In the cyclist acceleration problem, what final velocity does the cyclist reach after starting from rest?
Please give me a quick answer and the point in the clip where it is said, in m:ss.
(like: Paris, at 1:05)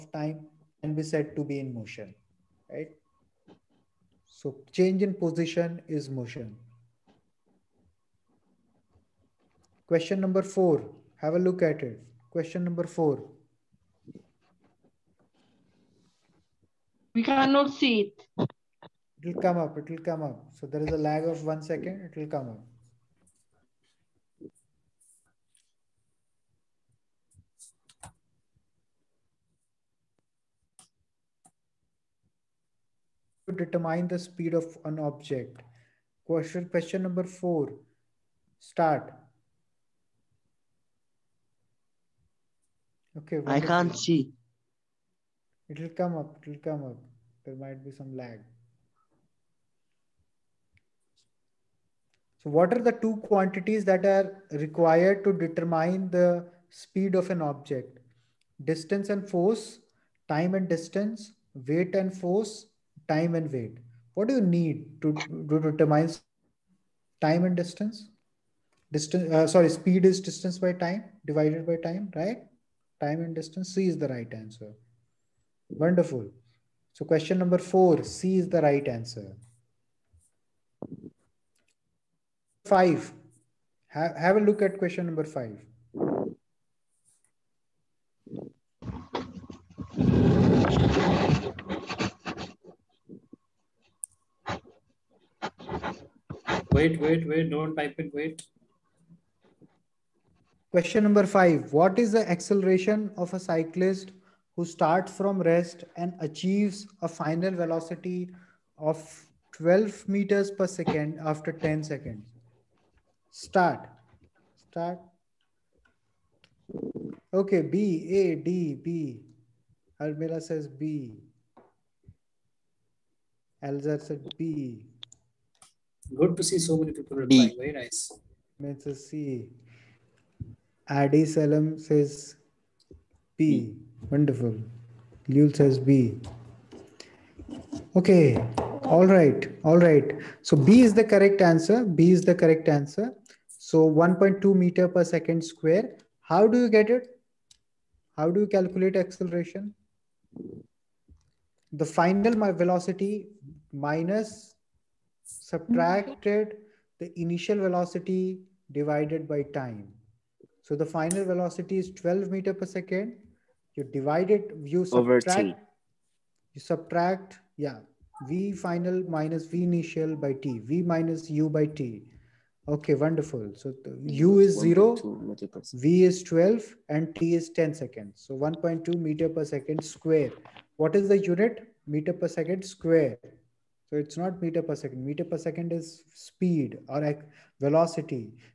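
12 meters per second, at 1:49.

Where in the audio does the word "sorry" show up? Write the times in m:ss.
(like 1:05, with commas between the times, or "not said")
1:09.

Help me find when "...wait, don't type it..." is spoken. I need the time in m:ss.
1:37.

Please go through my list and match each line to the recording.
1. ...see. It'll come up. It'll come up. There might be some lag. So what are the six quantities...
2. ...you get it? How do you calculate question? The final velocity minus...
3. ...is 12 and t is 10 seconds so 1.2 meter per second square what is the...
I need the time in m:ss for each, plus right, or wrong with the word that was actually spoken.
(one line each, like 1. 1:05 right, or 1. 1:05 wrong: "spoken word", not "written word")
1. 0:43 wrong: "two", not "six"
2. 2:26 wrong: "acceleration", not "question"
3. 2:56 right.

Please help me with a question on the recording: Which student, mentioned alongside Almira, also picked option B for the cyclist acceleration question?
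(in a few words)
Elzer.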